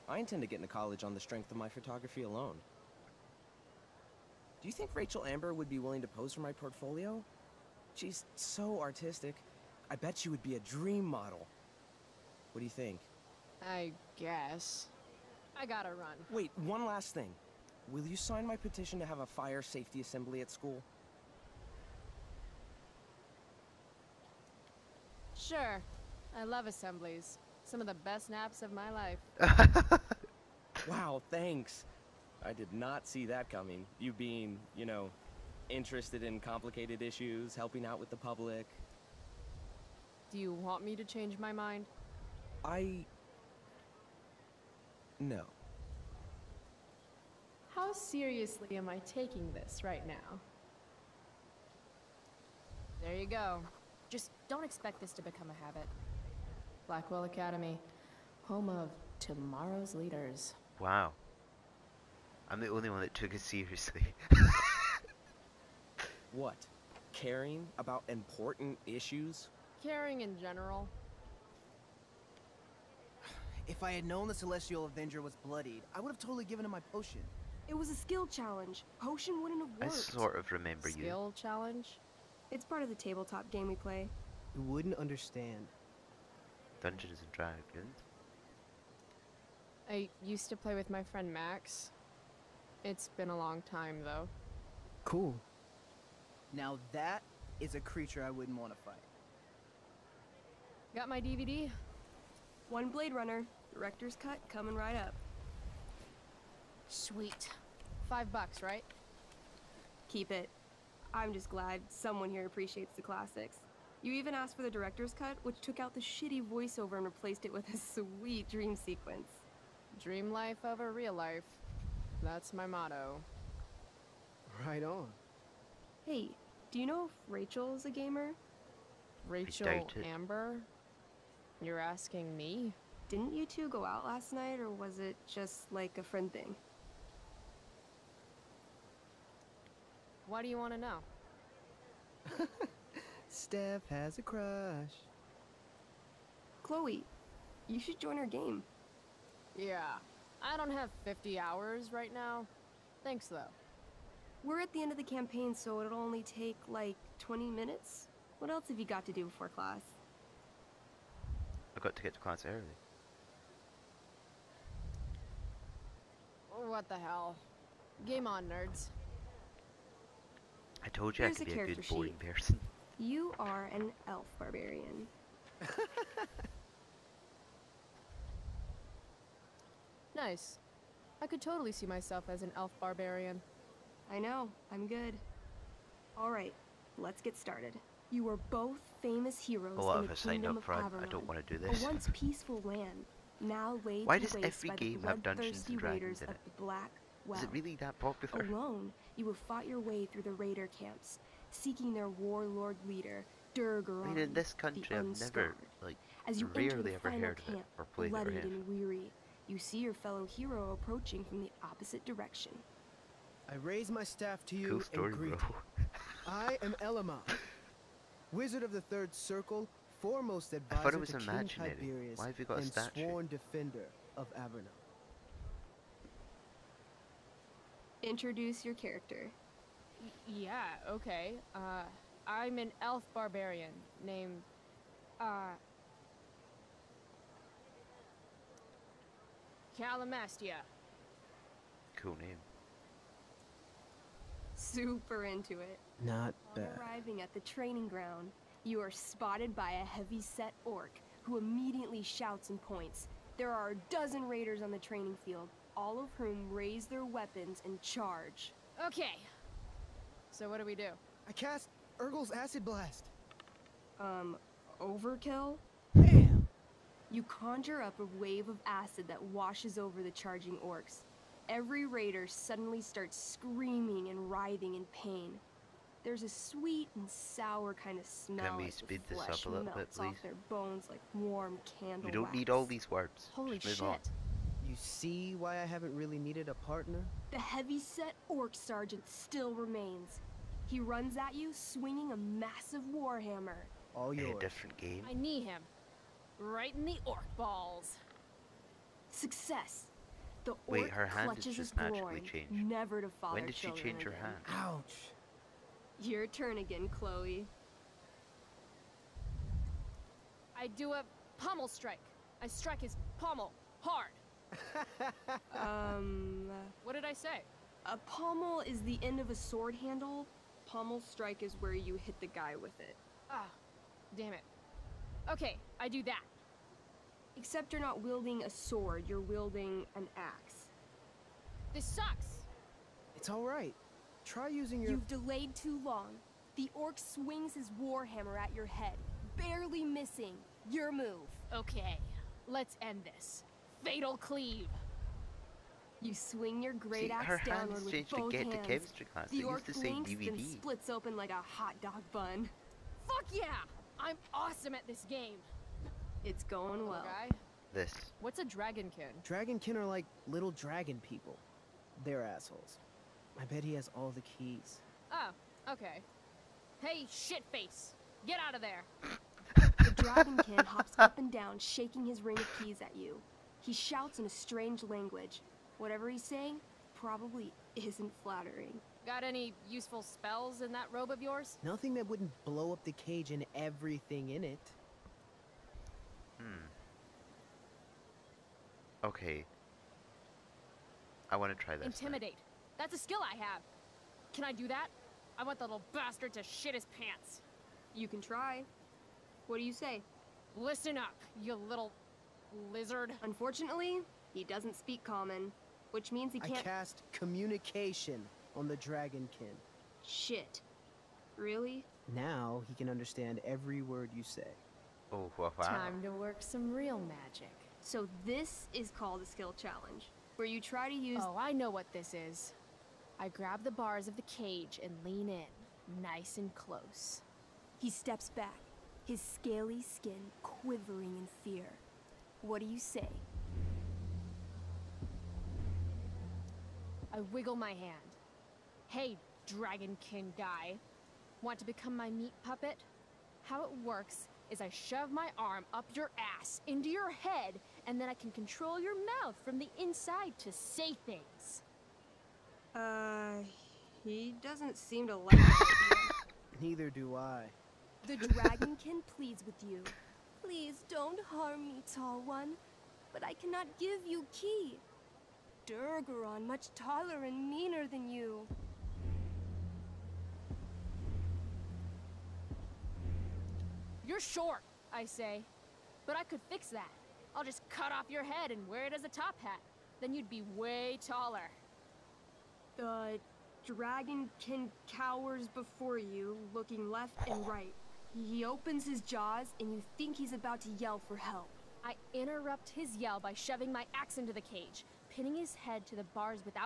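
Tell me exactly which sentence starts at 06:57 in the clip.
So this is called a skill challenge, where you try to use- Oh, I know what this is.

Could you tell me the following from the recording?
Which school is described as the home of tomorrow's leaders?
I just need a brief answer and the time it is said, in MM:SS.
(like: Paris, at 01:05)
Blackwell Academy, at 00:56.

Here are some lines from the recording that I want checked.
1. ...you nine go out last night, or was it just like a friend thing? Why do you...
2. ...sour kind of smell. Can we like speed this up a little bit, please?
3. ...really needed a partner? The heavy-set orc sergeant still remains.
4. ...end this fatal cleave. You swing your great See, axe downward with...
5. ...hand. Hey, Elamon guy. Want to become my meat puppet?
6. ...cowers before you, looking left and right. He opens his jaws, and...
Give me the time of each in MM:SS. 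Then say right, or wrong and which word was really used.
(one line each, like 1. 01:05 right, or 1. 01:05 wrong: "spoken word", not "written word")
1. 02:13 wrong: "two", not "nine"
2. 04:37 right
3. 04:45 right
4. 05:42 right
5. 07:17 wrong: "Dragonkin", not "Elamon"
6. 08:04 right.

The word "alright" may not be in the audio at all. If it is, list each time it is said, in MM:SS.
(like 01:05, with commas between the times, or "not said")
03:06, 05:33.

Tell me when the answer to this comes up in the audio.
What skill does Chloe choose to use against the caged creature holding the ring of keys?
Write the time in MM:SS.
06:31.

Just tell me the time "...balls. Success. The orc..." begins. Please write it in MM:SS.
04:57.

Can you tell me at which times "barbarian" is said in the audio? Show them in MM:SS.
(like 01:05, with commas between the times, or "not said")
02:54, 03:02, 03:53.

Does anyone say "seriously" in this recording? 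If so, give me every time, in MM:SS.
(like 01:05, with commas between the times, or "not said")
00:47, 01:03.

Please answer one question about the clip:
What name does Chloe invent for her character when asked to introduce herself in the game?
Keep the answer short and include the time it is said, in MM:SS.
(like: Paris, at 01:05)
Calamastia, at 03:59.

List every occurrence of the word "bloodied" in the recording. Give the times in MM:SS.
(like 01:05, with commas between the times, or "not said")
01:15, 03:28.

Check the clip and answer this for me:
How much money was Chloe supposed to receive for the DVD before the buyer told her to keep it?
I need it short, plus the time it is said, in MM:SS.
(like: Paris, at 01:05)
$5, at 01:48.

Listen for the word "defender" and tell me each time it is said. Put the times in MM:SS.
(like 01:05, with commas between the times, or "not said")
03:43.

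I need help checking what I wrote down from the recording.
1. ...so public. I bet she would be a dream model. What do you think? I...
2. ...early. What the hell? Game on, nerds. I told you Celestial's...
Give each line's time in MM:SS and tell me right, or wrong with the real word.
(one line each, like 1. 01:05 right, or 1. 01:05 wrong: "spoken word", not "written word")
1. 00:08 wrong: "artistic", not "public"
2. 02:42 wrong: "Here", not "Celestial".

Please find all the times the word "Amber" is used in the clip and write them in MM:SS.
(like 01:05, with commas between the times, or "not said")
00:05, 02:10.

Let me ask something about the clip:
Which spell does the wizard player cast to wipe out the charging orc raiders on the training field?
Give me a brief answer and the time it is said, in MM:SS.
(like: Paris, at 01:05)
Urgel's Acid Blast, at 04:21.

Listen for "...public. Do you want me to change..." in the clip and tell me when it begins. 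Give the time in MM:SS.
00:38.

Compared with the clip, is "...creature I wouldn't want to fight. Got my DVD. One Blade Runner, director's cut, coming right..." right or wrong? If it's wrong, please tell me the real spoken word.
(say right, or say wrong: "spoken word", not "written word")
right.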